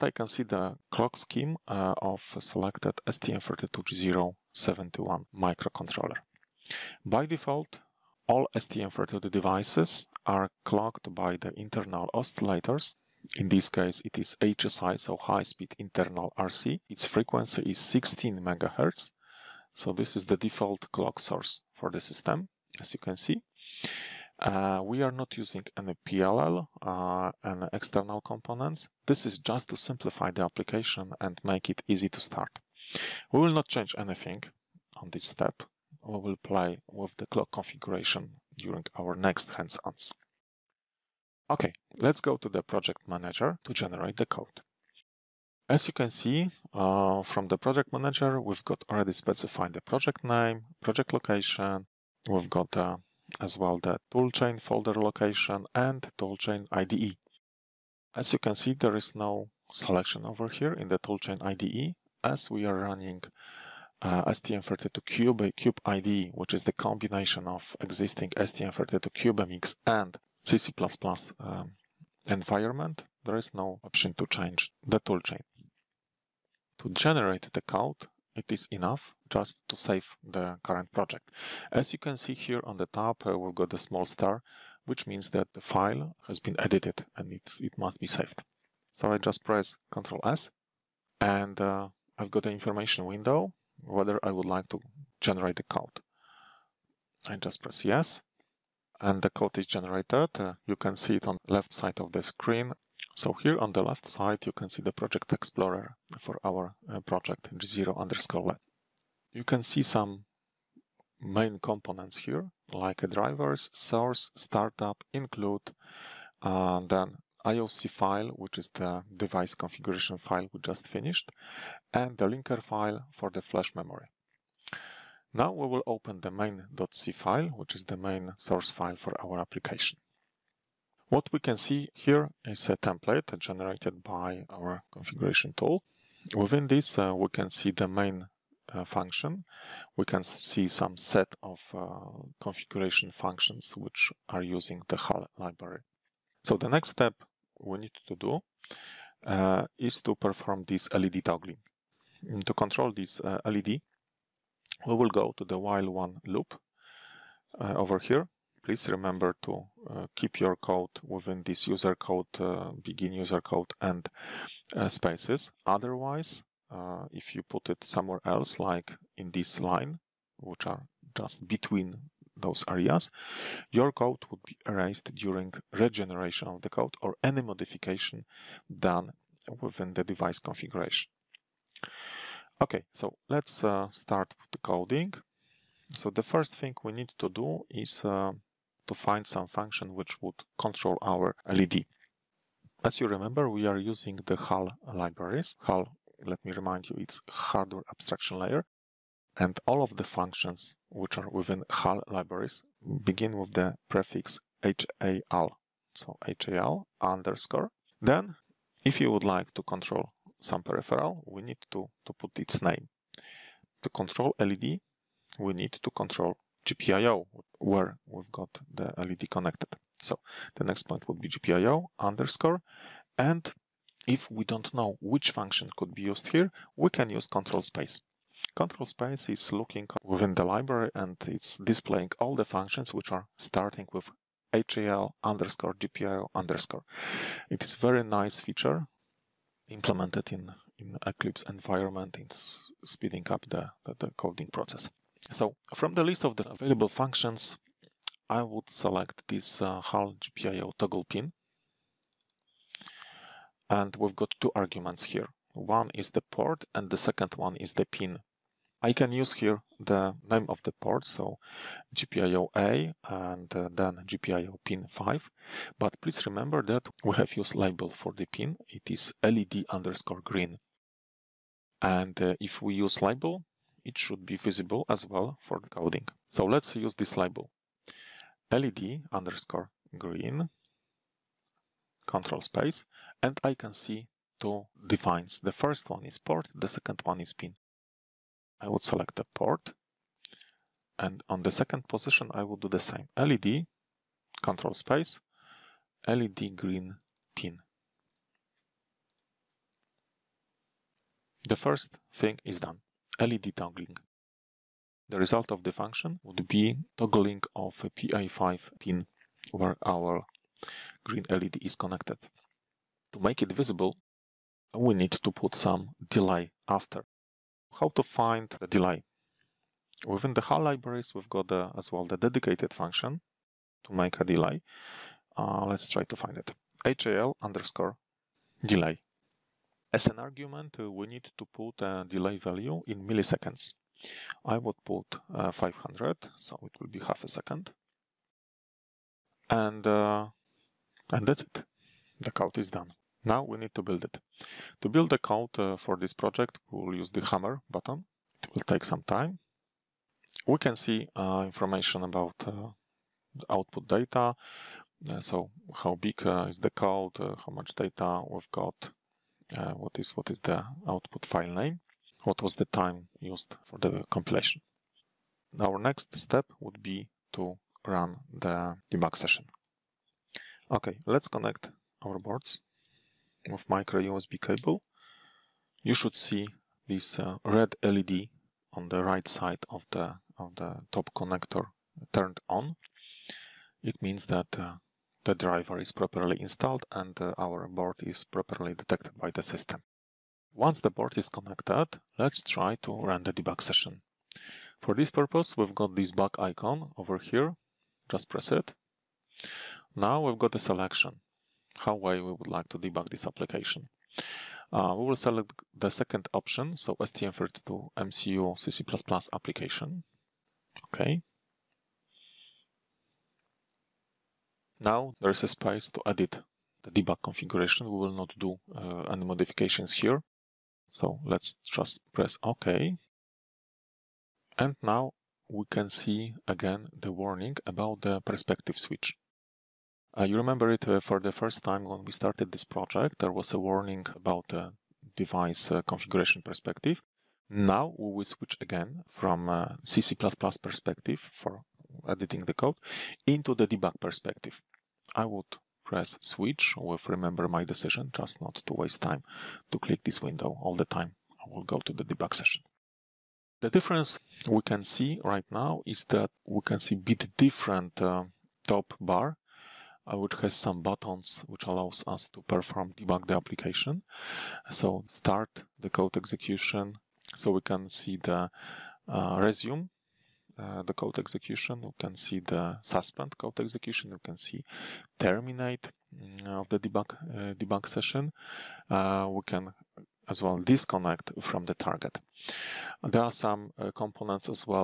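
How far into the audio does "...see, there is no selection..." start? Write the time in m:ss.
0:58.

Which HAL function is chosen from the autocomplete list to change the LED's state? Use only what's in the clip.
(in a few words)
HAL GPIO toggle pin.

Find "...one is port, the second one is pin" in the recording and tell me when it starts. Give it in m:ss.
4:45.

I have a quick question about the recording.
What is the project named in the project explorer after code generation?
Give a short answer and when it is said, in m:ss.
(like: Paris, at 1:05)
G0_lab, at 1:47.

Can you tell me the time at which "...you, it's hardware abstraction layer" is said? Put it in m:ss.
3:16.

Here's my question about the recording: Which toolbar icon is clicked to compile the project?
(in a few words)
hammer button.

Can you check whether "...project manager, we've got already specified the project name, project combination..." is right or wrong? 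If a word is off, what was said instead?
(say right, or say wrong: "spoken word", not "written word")
wrong: "location", not "combination".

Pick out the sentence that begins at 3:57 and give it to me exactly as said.
It is very nice feature implemented in, in Eclipse environment in speeding up the, the, the coding process.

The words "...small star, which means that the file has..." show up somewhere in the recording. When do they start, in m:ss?
1:23.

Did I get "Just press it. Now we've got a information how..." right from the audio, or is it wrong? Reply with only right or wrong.
wrong.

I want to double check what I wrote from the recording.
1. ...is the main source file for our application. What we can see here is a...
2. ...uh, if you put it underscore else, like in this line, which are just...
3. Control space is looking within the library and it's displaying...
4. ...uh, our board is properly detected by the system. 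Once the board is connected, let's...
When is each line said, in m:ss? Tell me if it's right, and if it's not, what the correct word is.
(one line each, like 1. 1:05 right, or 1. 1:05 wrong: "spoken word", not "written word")
1. 2:07 right
2. 2:46 wrong: "somewhere", not "underscore"
3. 3:48 right
4. 6:27 right.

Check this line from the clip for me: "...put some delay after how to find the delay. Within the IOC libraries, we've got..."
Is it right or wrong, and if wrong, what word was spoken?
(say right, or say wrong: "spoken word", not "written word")
wrong: "HAL", not "IOC".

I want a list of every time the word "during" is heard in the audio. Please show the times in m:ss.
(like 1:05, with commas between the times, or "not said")
0:38, 2:55.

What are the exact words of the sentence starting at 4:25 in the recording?
But please remember that we have used label for the pin.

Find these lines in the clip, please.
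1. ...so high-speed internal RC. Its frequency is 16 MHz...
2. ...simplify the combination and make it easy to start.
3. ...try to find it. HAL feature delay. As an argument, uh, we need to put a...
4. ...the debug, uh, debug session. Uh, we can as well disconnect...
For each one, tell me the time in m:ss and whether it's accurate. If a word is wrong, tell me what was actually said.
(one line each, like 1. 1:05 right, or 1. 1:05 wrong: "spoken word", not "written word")
1. 0:14 right
2. 0:29 wrong: "application", not "combination"
3. 5:25 wrong: "underscore", not "feature"
4. 7:56 right.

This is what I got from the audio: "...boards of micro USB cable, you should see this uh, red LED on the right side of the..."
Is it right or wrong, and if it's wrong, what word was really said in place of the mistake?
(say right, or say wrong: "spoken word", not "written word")
right.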